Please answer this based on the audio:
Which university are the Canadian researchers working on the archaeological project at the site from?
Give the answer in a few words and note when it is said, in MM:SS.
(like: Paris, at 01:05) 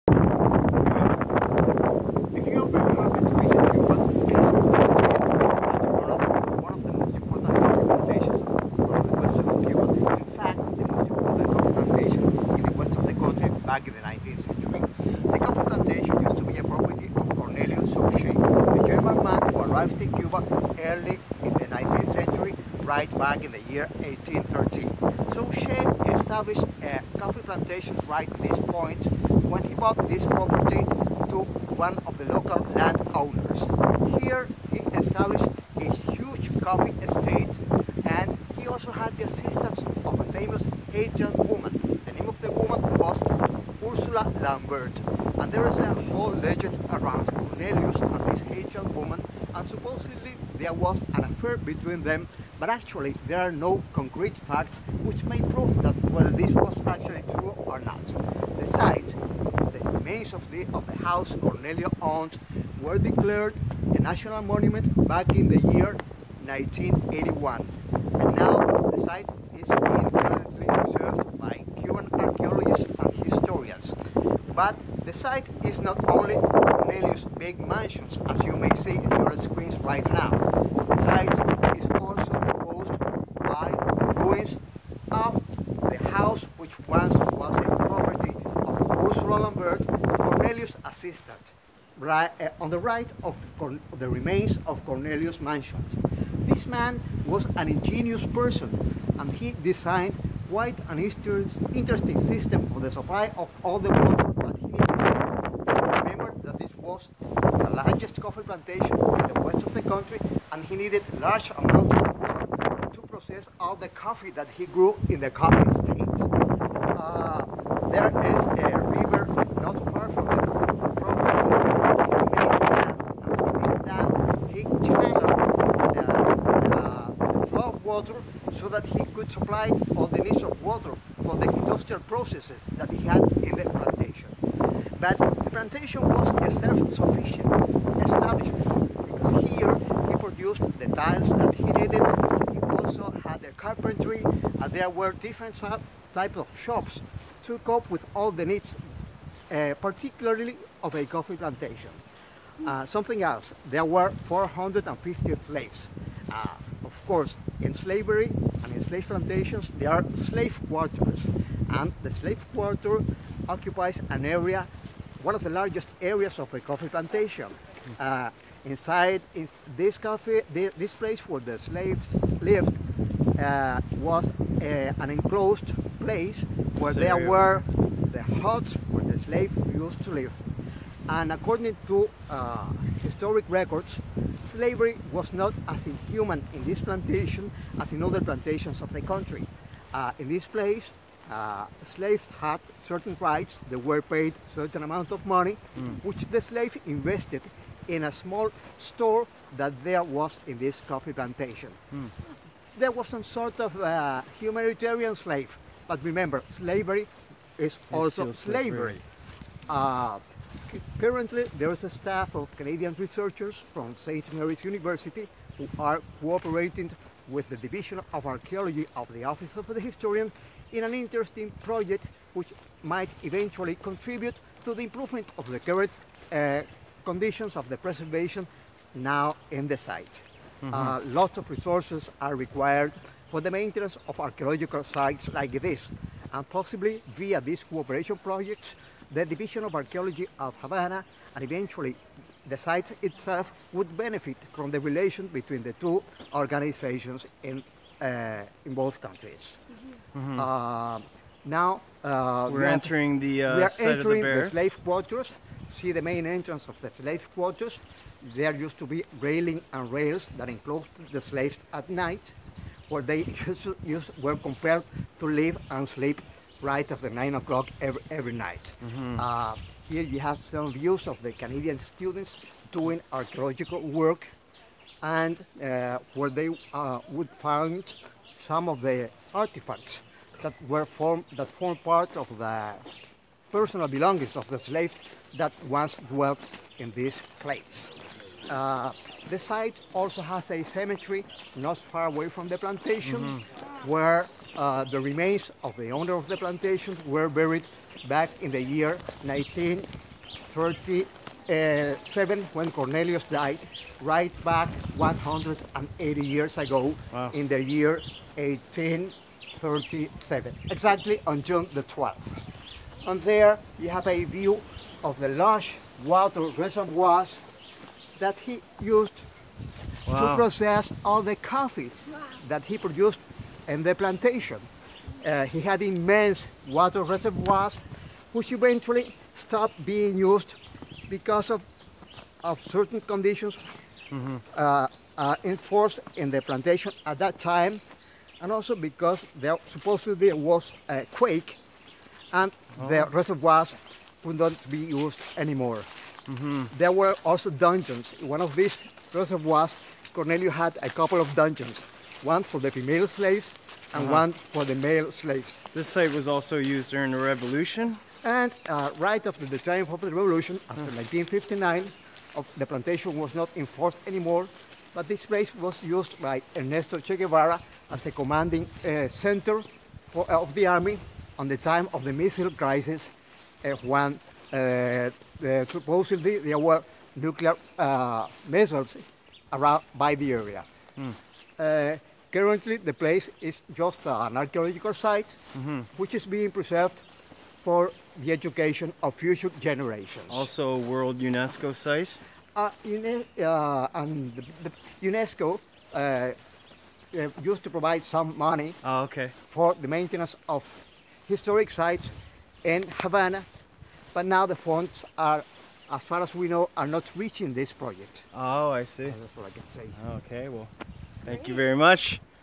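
St. Mary's University, at 03:34.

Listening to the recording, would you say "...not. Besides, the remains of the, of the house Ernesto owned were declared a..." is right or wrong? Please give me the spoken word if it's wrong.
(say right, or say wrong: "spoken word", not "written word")
wrong: "Cornelius", not "Ernesto".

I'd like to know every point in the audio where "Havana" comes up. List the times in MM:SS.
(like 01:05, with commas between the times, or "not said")
04:00, 06:43.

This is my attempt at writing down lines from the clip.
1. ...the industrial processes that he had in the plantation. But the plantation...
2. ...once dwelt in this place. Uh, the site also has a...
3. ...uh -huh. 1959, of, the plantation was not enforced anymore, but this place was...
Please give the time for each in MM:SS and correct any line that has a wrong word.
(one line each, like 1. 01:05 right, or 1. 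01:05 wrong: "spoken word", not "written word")
1. 02:11 right
2. 04:45 right
3. 06:00 right.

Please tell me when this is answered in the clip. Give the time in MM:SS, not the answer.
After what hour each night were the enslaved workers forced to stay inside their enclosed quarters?
04:27.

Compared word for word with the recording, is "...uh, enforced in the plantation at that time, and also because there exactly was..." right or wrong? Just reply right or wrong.
wrong.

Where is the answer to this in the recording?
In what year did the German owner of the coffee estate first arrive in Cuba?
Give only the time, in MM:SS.
00:24.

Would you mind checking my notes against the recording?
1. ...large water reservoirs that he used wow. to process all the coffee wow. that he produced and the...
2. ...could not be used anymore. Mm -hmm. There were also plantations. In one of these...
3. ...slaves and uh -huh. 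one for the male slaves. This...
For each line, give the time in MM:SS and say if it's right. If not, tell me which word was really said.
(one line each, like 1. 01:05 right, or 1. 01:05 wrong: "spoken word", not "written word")
1. 05:15 right
2. 05:44 wrong: "dungeons", not "plantations"
3. 05:53 right.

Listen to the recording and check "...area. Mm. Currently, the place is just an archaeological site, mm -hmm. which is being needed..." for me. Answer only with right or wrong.
wrong.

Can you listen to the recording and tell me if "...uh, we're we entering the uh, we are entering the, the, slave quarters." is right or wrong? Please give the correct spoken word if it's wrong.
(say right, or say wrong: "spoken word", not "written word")
right.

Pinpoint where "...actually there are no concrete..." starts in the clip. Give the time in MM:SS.
00:52.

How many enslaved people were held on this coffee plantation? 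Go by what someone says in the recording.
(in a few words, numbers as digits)
450.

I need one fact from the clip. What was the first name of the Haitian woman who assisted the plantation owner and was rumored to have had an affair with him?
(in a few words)
Ursula.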